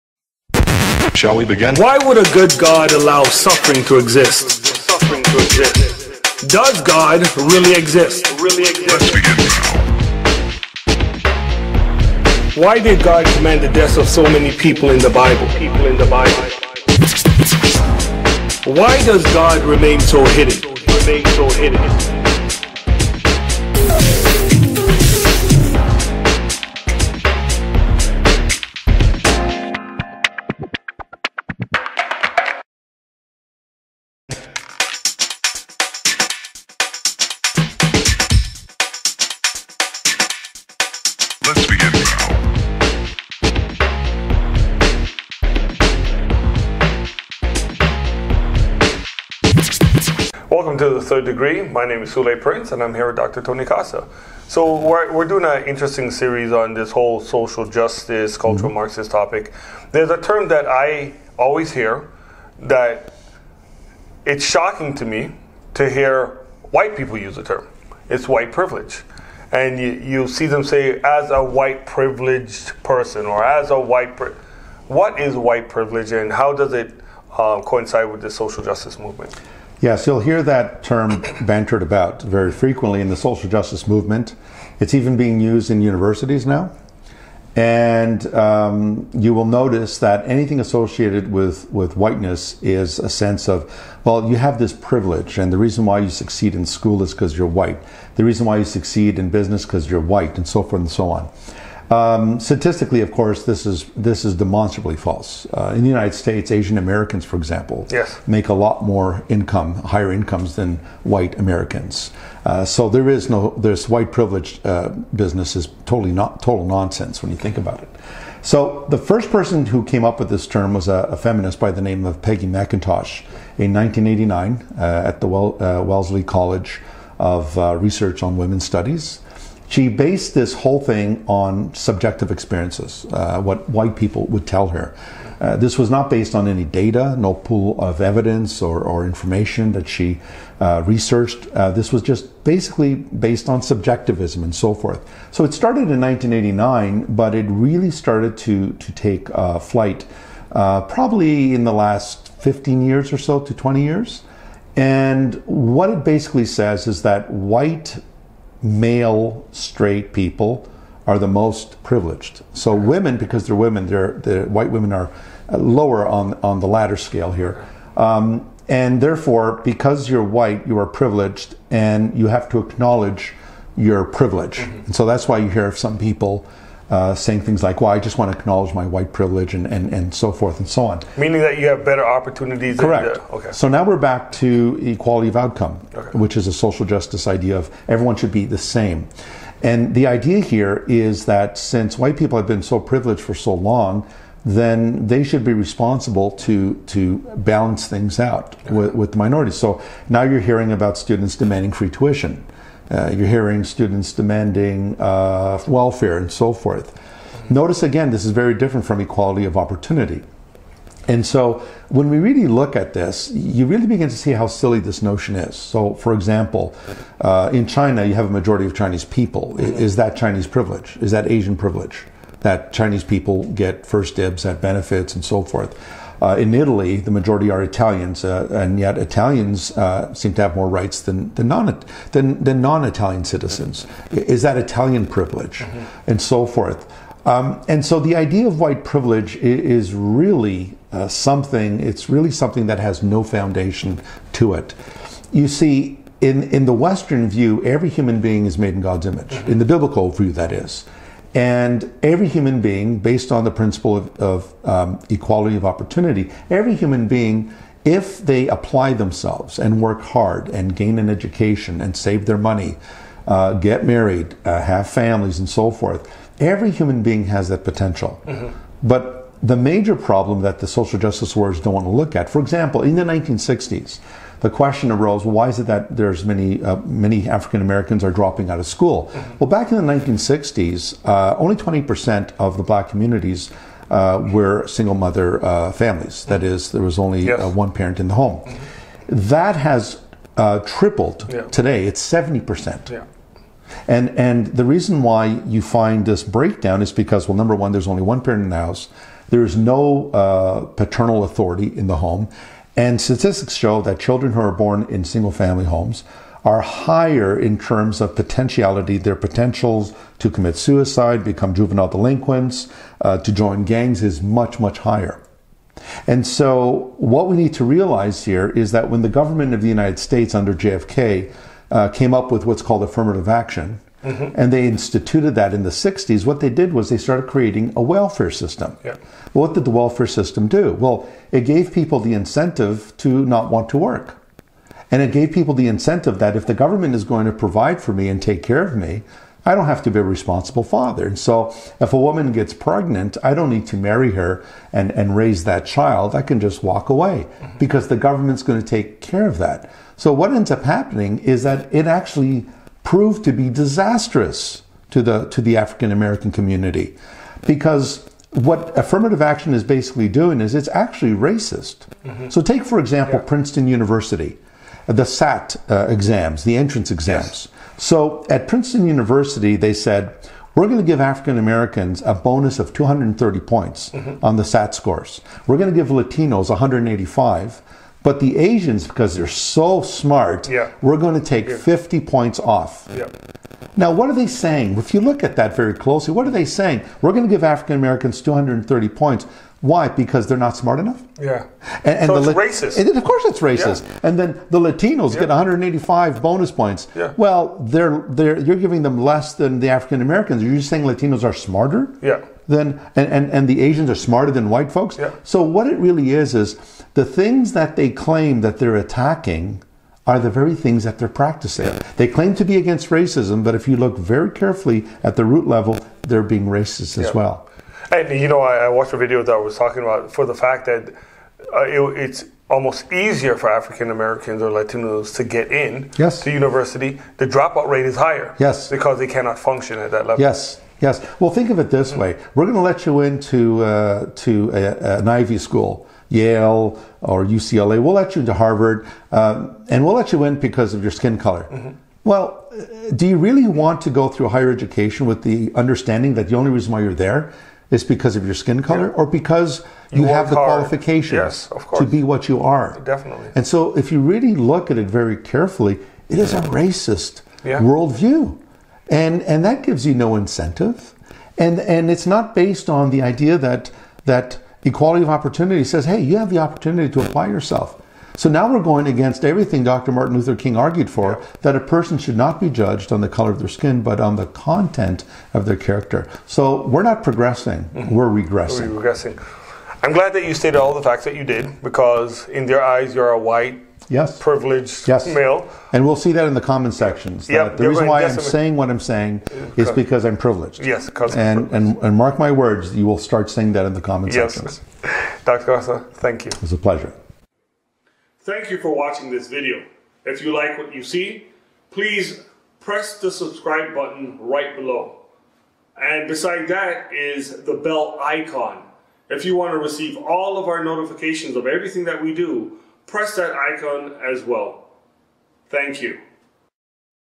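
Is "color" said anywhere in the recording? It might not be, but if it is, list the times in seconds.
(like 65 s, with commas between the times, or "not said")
441 s, 448 s, 473 s.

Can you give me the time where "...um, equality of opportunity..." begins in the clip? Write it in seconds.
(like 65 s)
254 s.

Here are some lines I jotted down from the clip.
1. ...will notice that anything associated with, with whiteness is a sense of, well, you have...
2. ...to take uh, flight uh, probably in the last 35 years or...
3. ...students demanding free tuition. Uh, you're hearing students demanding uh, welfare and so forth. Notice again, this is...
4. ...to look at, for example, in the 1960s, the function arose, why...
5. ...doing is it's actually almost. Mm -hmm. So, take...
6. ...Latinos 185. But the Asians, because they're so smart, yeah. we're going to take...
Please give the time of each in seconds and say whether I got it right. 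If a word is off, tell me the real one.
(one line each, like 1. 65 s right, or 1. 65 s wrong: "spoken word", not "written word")
1. 89 s right
2. 148 s wrong: "15", not "35"
3. 200 s right
4. 271 s wrong: "question", not "function"
5. 360 s wrong: "racist", not "almost"
6. 375 s right.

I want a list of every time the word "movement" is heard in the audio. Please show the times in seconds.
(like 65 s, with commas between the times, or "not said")
78 s, 83 s.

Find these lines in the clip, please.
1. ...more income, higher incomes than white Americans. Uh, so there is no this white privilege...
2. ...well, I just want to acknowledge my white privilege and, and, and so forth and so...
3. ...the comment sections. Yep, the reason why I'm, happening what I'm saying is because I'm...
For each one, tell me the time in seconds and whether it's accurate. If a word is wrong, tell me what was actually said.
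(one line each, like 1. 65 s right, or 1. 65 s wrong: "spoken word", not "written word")
1. 108 s right
2. 177 s right
3. 486 s wrong: "saying", not "happening".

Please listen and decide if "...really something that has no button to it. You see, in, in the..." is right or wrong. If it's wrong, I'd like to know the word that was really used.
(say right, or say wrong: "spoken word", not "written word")
wrong: "foundation", not "button".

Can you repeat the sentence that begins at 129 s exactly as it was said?
She based this whole thing on subjective experiences, uh, what white people would tell her.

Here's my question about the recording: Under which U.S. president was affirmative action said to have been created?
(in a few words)
JFK.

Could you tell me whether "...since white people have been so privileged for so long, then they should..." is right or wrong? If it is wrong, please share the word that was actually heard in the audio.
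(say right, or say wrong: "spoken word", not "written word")
right.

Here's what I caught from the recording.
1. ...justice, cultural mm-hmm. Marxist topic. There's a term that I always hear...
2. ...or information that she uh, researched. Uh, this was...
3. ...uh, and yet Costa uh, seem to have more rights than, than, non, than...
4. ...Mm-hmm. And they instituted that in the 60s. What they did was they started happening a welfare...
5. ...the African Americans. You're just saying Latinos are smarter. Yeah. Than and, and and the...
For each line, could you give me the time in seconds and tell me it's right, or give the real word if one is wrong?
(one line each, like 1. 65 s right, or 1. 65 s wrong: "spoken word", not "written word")
1. 57 s right
2. 138 s right
3. 228 s wrong: "Italians", not "Costa"
4. 324 s wrong: "creating", not "happening"
5. 399 s right.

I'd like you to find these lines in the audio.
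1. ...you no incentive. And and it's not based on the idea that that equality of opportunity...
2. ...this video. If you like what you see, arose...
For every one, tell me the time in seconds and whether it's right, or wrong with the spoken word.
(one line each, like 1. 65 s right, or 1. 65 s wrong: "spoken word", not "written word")
1. 459 s right
2. 499 s wrong: "please", not "arose".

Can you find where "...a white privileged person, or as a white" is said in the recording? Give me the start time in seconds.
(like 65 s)
71 s.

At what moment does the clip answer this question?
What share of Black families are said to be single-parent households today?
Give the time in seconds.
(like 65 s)
292 s.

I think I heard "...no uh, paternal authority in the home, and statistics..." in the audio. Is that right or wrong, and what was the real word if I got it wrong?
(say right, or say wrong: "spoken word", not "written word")
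right.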